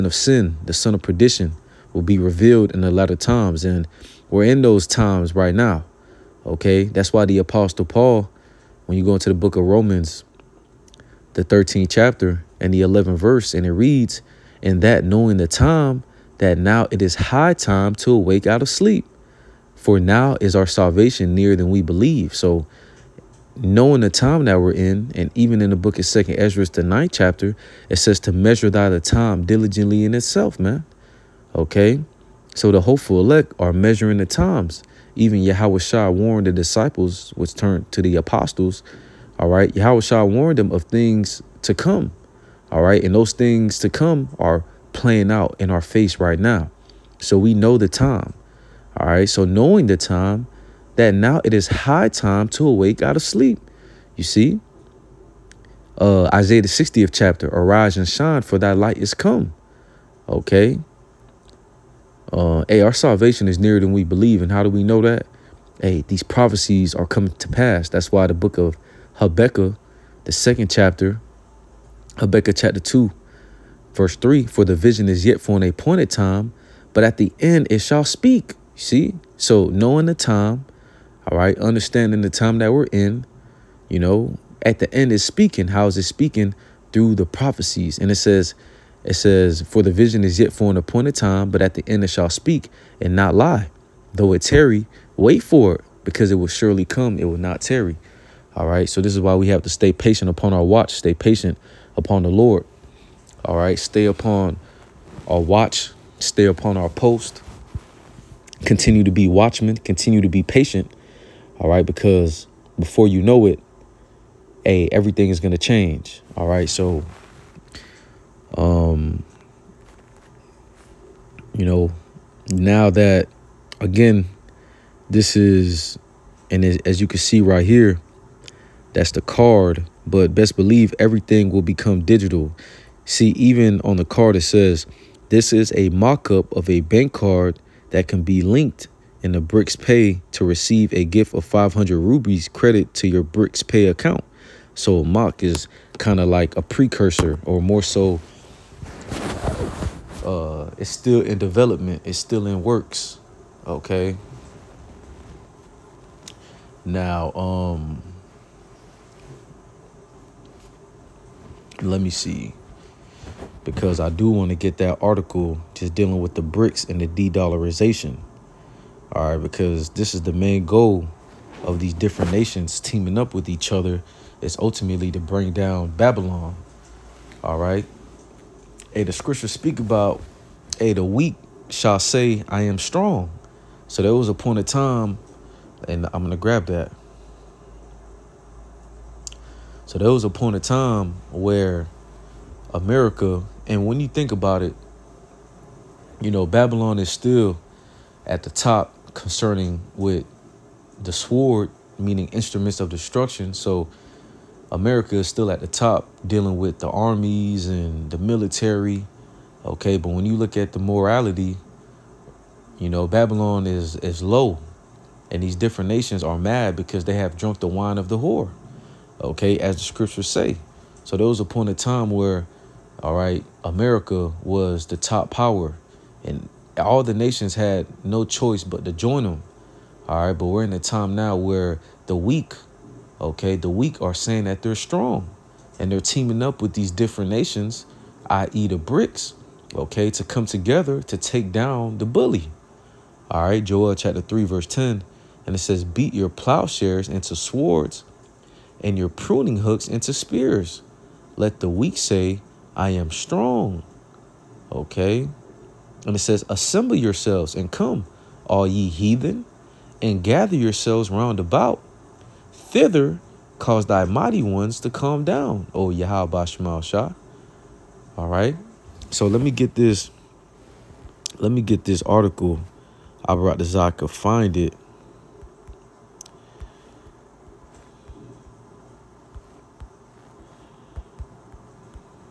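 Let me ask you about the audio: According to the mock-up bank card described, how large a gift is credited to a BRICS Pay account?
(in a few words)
500 rubles.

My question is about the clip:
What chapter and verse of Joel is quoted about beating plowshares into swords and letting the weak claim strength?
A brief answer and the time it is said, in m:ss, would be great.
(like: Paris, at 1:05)
Chapter 3, verse 10, at 4:03.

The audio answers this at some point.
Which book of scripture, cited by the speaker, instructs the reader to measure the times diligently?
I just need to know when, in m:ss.
0:26.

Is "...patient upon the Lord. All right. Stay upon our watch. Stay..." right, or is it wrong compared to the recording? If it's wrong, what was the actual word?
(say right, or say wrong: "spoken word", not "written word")
right.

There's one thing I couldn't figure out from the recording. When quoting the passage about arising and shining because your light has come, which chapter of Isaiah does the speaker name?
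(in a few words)
60th chapter.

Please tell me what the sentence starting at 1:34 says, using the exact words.
Though it tarry, wait for it, because it will surely come, it will not tarry.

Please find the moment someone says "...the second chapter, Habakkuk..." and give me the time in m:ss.
1:10.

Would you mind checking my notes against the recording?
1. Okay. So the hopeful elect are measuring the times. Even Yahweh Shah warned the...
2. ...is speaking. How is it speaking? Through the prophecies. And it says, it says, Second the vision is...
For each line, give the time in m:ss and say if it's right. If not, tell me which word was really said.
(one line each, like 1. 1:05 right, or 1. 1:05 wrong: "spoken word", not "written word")
1. 0:31 right
2. 1:25 wrong: "For", not "Second".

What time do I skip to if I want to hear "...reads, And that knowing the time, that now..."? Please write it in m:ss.
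0:13.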